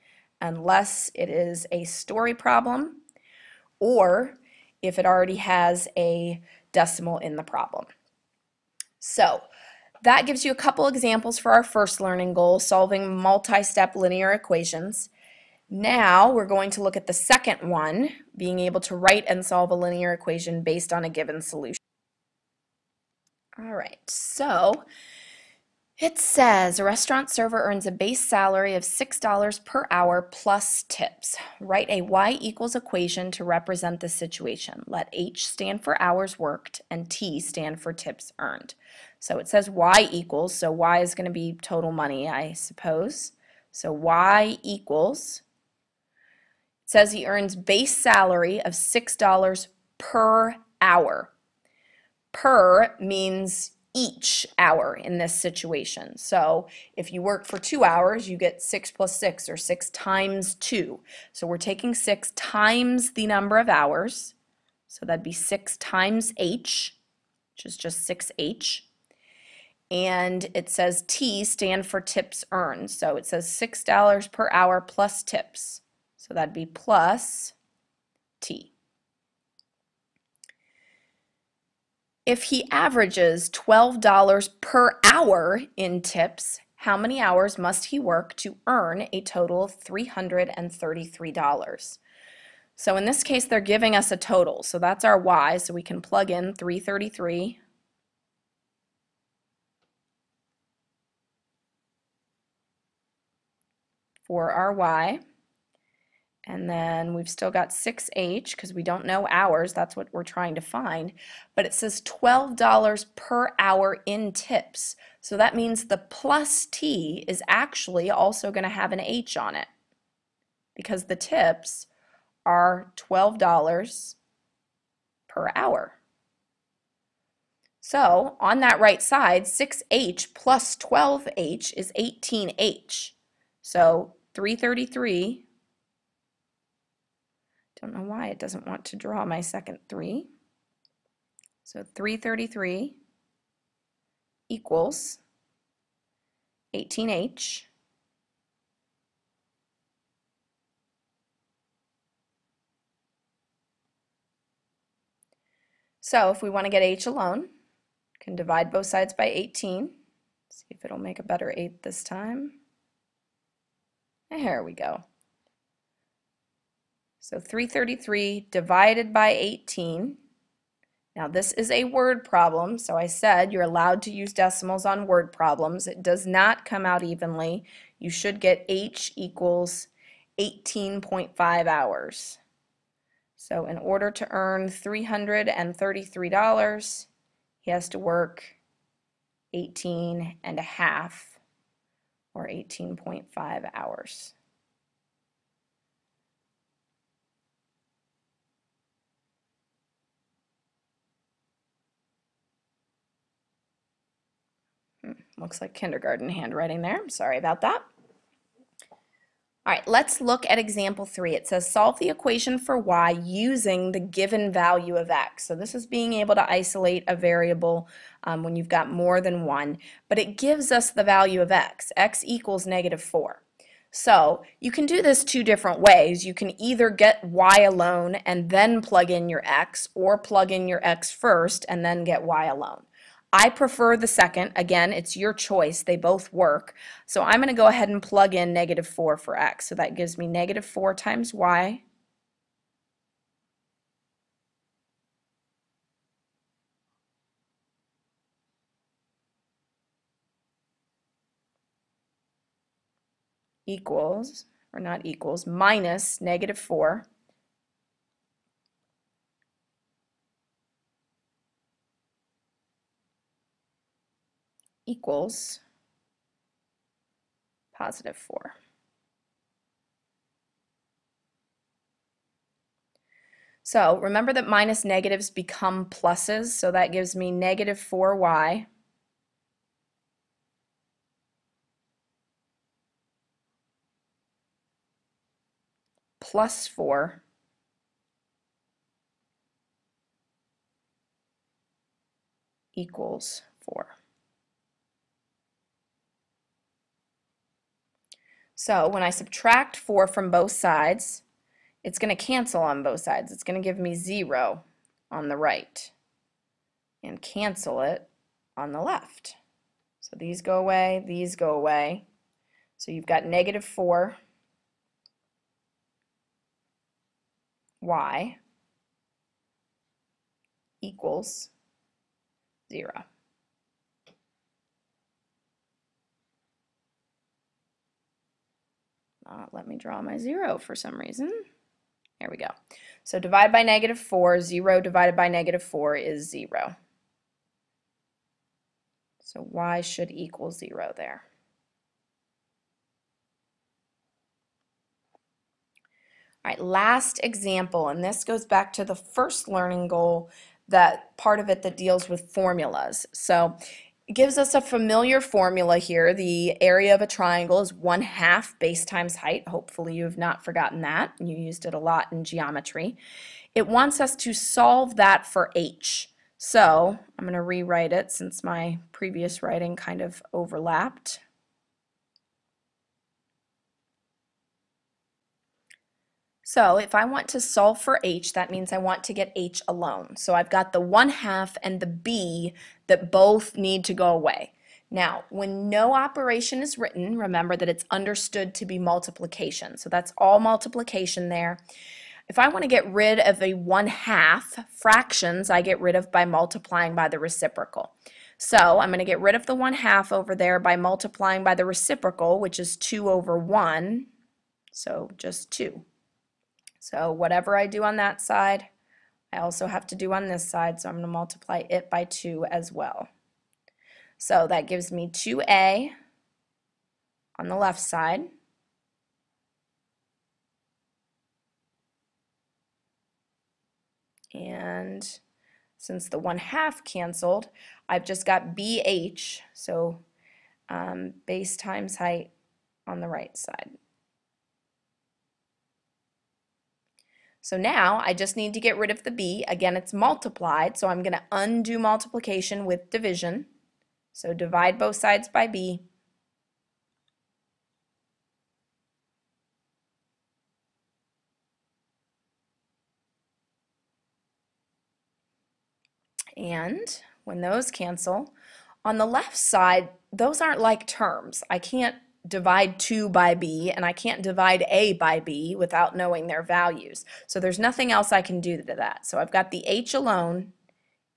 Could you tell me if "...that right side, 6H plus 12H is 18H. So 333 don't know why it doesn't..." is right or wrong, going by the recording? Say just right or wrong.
right.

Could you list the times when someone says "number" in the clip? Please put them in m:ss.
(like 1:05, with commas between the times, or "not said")
1:03.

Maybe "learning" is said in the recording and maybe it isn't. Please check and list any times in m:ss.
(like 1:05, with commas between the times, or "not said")
0:12, 5:49.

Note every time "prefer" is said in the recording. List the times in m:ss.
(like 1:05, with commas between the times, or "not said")
3:53.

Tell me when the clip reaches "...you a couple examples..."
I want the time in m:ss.
0:10.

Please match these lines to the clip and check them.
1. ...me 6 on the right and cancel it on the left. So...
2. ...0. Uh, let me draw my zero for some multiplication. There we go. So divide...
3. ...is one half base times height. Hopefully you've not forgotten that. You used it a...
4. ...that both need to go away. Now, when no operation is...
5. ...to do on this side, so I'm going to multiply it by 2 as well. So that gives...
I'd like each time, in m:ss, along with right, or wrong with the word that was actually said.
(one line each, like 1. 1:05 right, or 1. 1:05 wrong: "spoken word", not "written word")
1. 5:03 wrong: "0", not "6"
2. 5:22 wrong: "reason", not "multiplication"
3. 5:57 right
4. 6:22 right
5. 6:49 right.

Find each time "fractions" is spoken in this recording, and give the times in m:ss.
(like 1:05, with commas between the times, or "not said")
6:34.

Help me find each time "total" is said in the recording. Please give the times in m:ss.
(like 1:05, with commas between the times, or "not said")
0:41, 1:29, 1:34.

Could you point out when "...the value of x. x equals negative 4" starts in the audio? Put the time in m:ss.
3:40.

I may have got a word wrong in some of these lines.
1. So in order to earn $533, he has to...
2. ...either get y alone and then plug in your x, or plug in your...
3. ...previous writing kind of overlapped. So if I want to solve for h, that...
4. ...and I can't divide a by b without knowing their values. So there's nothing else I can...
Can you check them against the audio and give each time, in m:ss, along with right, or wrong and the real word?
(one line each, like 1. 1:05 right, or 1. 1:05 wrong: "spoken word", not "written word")
1. 3:03 wrong: "333", not "533"
2. 3:46 right
3. 6:08 right
4. 7:43 right.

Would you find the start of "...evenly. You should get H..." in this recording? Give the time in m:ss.
2:57.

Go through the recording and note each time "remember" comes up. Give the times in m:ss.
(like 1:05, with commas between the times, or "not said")
4:33, 6:27.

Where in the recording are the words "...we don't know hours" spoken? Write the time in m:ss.
1:48.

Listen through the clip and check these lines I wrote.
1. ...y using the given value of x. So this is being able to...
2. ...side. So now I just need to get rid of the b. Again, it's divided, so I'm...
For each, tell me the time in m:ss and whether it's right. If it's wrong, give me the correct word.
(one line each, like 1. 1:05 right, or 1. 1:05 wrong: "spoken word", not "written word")
1. 3:32 right
2. 7:13 wrong: "multiplied", not "divided".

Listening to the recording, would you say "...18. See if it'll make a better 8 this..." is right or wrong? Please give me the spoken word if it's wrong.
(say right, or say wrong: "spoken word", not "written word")
right.